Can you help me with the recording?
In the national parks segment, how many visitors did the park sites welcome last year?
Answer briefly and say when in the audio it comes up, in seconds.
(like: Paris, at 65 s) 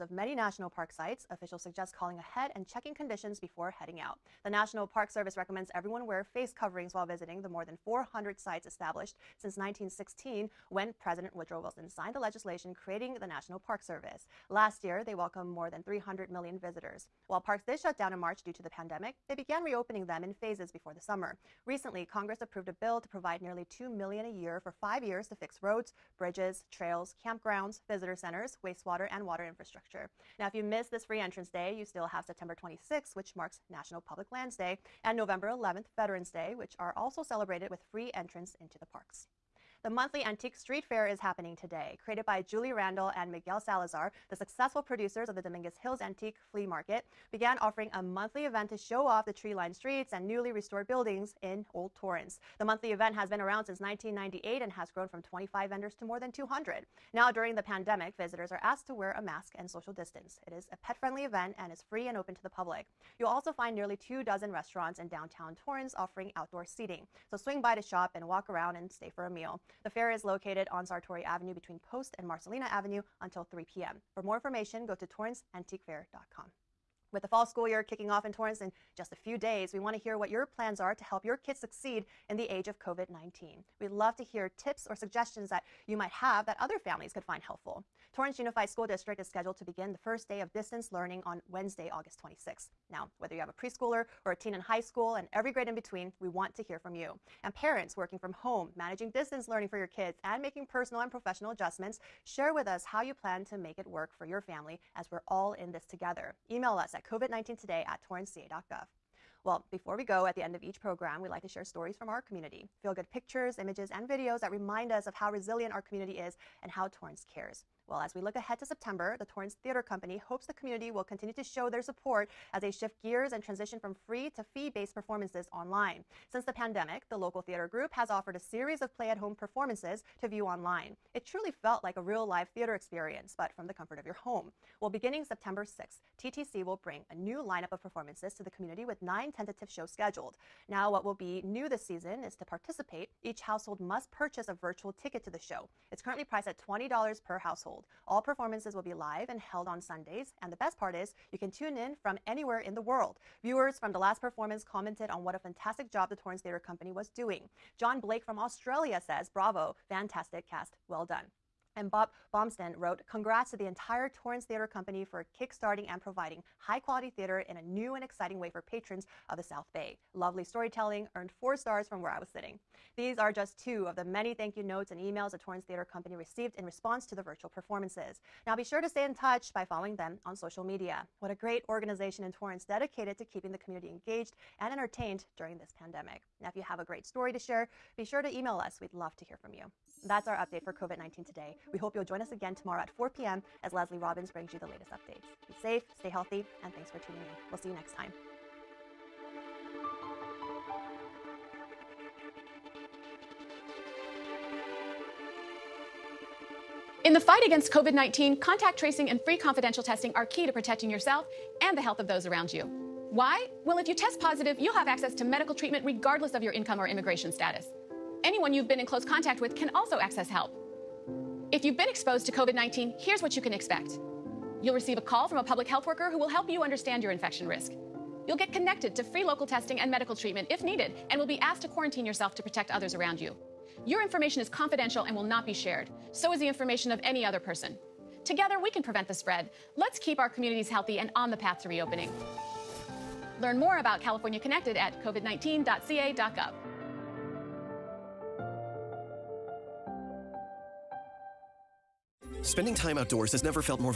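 more than 300 million, at 15 s.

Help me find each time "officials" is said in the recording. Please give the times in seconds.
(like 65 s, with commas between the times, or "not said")
1 s.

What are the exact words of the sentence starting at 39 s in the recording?
The monthly Antique Street Fair is happening today.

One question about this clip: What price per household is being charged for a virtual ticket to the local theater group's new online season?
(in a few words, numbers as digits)
$20.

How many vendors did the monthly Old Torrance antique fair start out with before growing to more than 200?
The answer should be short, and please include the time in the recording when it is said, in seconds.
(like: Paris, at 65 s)
25, at 55 s.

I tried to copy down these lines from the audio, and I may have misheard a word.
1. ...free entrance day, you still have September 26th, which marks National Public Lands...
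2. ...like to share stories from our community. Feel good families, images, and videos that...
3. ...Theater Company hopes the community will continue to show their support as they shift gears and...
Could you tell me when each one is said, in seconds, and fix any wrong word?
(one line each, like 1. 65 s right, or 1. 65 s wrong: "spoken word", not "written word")
1. 31 s right
2. 111 s wrong: "pictures", not "families"
3. 119 s right.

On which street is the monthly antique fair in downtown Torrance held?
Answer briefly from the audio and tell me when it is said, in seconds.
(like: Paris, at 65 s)
Sartori Avenue, at 70 s.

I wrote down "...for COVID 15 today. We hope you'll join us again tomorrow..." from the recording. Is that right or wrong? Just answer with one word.
wrong.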